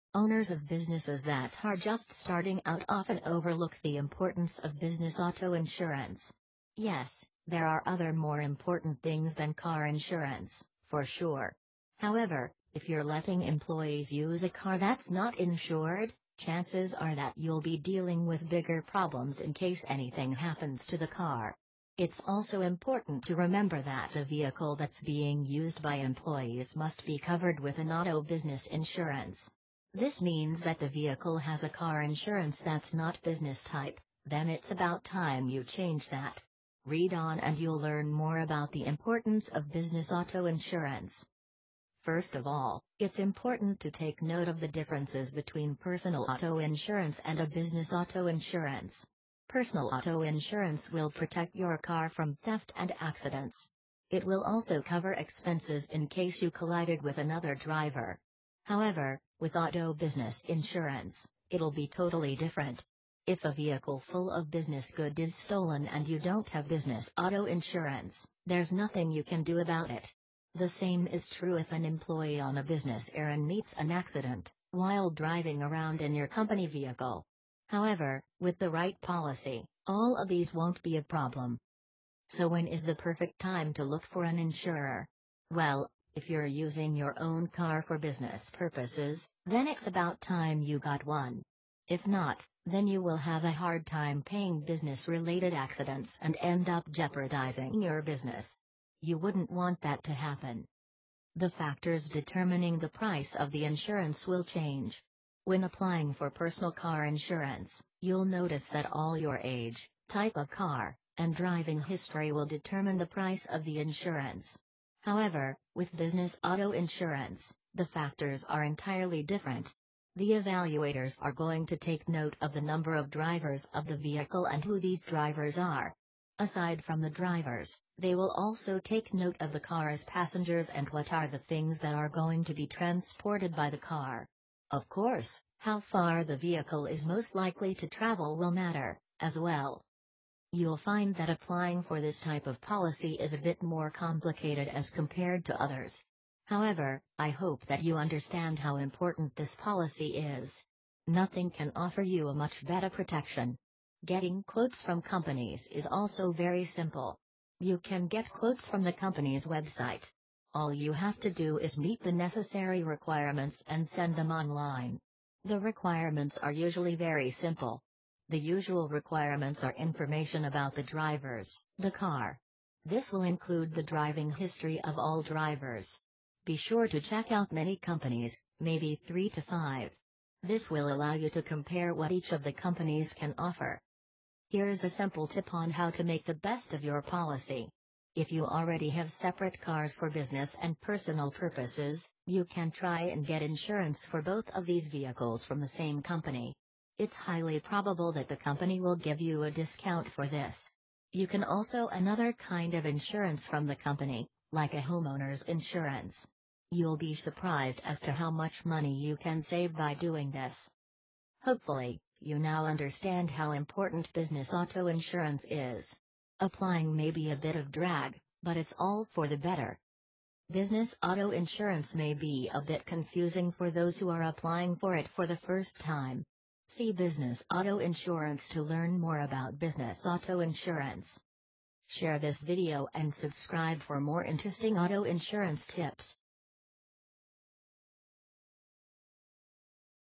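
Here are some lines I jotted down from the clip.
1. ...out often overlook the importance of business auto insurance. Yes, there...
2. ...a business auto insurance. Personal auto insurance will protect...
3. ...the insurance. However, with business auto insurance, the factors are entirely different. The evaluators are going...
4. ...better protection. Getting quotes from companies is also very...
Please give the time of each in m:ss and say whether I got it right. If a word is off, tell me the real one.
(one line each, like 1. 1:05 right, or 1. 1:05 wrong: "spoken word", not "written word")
1. 0:02 right
2. 0:47 right
3. 1:53 right
4. 2:32 right.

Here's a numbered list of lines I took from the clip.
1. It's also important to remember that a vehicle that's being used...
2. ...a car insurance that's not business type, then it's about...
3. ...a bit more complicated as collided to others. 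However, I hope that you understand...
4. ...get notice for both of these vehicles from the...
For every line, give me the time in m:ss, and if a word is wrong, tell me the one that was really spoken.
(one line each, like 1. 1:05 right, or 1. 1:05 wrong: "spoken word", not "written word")
1. 0:21 right
2. 0:31 right
3. 2:23 wrong: "compared", not "collided"
4. 3:13 wrong: "insurance", not "notice".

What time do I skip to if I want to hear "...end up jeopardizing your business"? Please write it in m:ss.
1:36.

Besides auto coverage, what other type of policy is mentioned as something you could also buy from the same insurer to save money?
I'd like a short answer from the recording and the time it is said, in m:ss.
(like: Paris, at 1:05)
homeowner's insurance, at 3:24.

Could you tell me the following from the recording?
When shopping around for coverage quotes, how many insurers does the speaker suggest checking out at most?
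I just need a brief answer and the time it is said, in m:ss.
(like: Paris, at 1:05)
5, at 2:59.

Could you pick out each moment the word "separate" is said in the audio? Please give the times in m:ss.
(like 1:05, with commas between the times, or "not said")
3:09.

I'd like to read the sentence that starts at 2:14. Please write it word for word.
Of course, how far the vehicle is most likely to travel will matter, as well.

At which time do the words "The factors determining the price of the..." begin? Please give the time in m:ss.
1:41.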